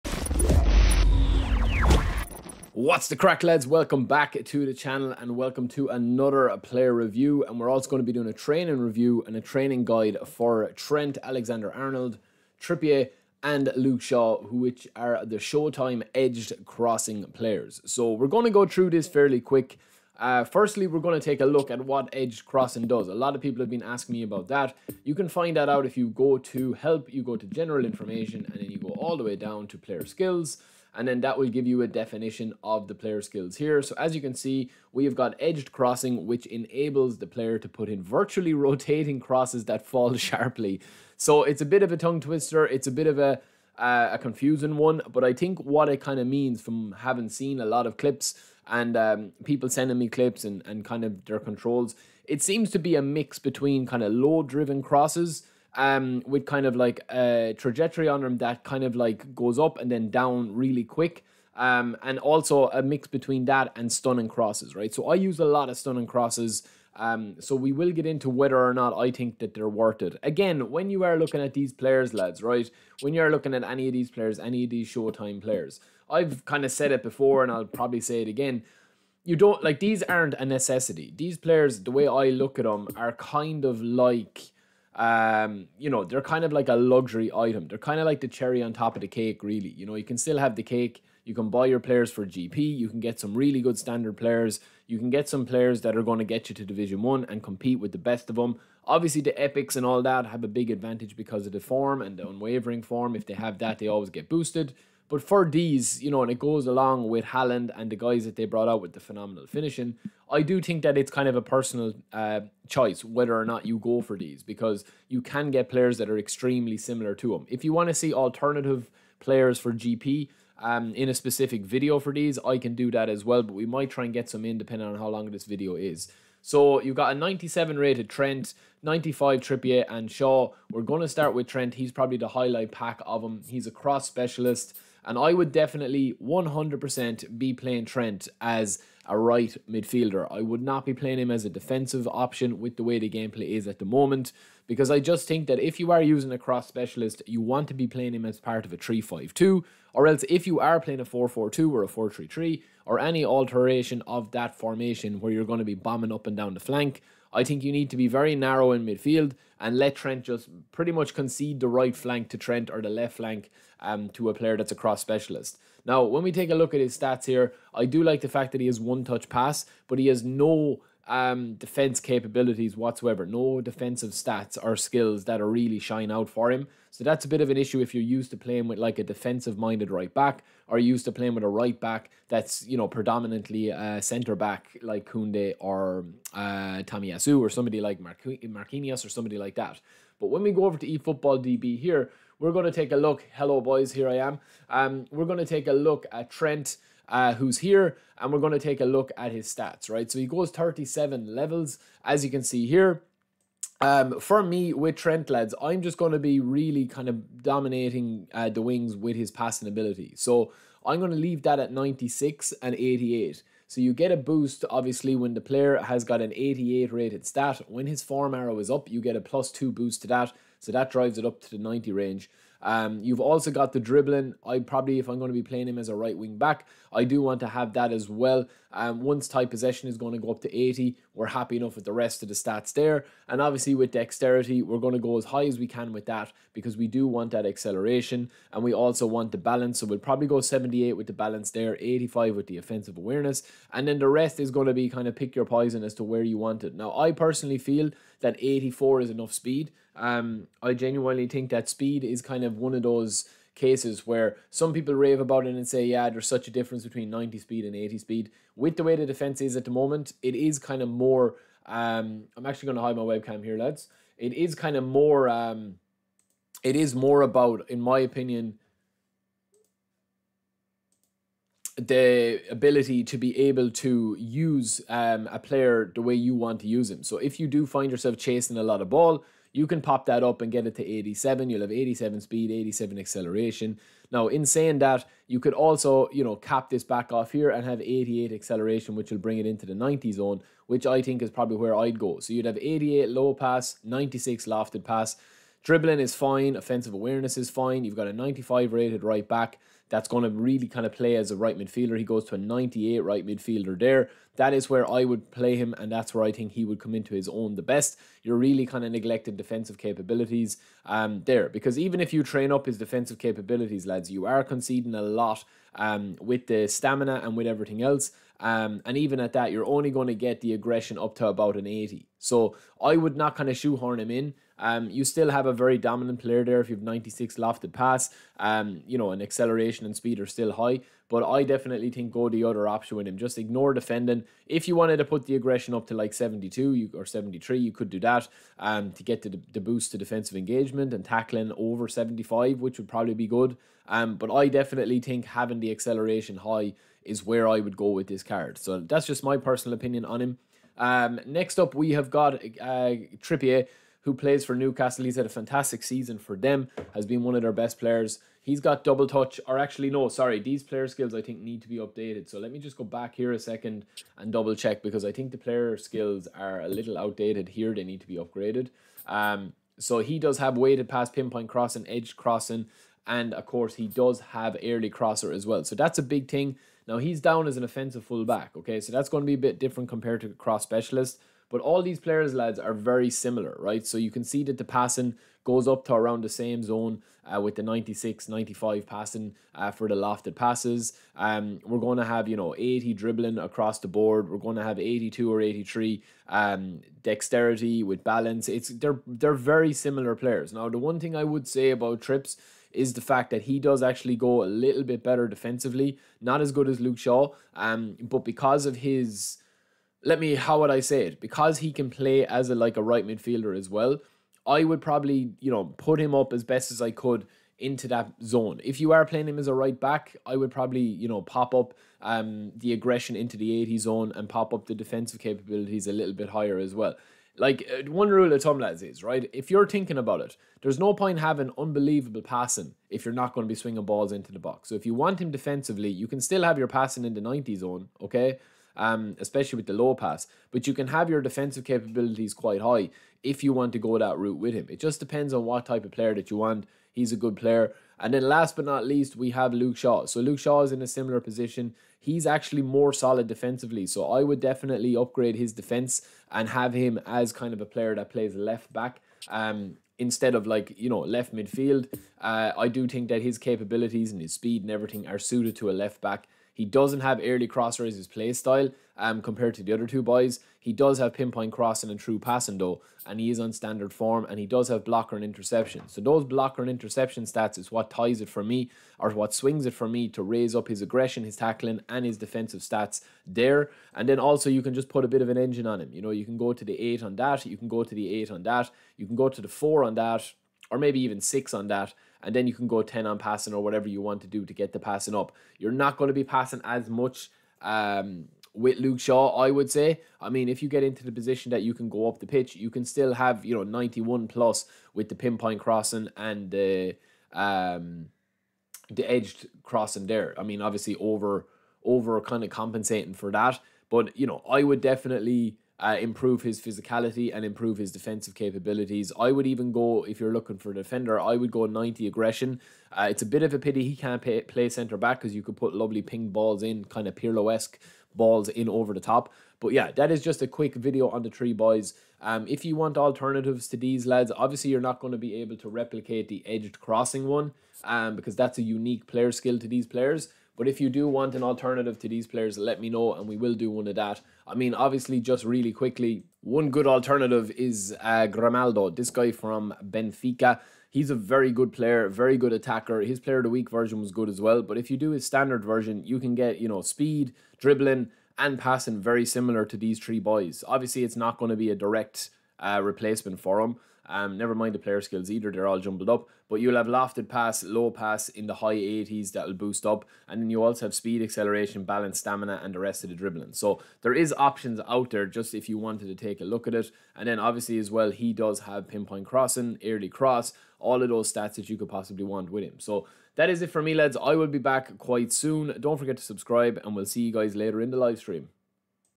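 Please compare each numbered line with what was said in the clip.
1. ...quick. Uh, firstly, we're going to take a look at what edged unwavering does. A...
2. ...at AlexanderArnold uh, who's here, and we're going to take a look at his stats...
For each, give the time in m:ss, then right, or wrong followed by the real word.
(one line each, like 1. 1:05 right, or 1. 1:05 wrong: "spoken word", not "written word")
1. 0:19 wrong: "crossing", not "unwavering"
2. 3:16 wrong: "Trent", not "AlexanderArnold".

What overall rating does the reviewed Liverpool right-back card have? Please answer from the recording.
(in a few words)
97.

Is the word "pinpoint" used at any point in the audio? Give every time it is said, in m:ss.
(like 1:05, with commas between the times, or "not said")
6:11, 7:51, 8:25, 9:38.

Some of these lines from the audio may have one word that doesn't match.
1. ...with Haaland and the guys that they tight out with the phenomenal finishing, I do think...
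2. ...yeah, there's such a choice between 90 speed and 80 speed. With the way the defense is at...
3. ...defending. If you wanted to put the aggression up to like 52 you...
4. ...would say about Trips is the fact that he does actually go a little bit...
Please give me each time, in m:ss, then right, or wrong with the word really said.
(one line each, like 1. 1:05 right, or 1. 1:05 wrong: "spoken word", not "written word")
1. 1:47 wrong: "brought", not "tight"
2. 4:15 wrong: "difference", not "choice"
3. 5:33 wrong: "72", not "52"
4. 6:41 right.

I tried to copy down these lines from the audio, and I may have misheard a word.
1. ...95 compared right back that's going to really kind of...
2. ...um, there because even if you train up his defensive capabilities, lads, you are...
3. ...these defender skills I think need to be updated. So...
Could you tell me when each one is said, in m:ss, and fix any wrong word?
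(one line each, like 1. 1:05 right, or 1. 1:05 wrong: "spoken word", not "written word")
1. 4:58 wrong: "rated", not "compared"
2. 5:10 right
3. 6:00 wrong: "player", not "defender".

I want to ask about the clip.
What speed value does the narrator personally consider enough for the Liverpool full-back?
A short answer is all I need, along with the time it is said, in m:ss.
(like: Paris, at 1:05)
84, at 4:08.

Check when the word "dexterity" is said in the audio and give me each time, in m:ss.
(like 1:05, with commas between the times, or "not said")
3:53, 6:37.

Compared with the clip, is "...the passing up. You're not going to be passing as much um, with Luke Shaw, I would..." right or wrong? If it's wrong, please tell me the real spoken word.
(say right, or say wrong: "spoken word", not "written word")
right.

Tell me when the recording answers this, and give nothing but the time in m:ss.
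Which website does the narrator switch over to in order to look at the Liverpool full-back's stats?
3:10.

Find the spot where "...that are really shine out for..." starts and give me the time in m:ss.
2:55.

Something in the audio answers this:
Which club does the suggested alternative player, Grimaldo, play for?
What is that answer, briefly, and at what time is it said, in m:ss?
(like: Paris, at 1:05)
Benfica, at 9:09.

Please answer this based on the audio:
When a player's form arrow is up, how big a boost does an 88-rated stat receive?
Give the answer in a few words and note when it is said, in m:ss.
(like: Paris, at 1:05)
Plus 2, at 3:39.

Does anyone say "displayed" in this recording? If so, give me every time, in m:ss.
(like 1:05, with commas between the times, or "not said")
not said.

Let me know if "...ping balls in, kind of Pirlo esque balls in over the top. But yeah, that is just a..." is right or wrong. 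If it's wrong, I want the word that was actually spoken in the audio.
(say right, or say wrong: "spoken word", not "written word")
right.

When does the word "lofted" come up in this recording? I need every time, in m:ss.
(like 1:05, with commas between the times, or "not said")
4:54, 5:27, 6:29, 9:26.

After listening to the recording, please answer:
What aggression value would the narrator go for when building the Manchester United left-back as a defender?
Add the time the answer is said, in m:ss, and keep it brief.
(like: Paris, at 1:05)
90, at 8:41.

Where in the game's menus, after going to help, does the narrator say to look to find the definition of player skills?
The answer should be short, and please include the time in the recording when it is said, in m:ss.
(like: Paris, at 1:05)
General information, at 0:27.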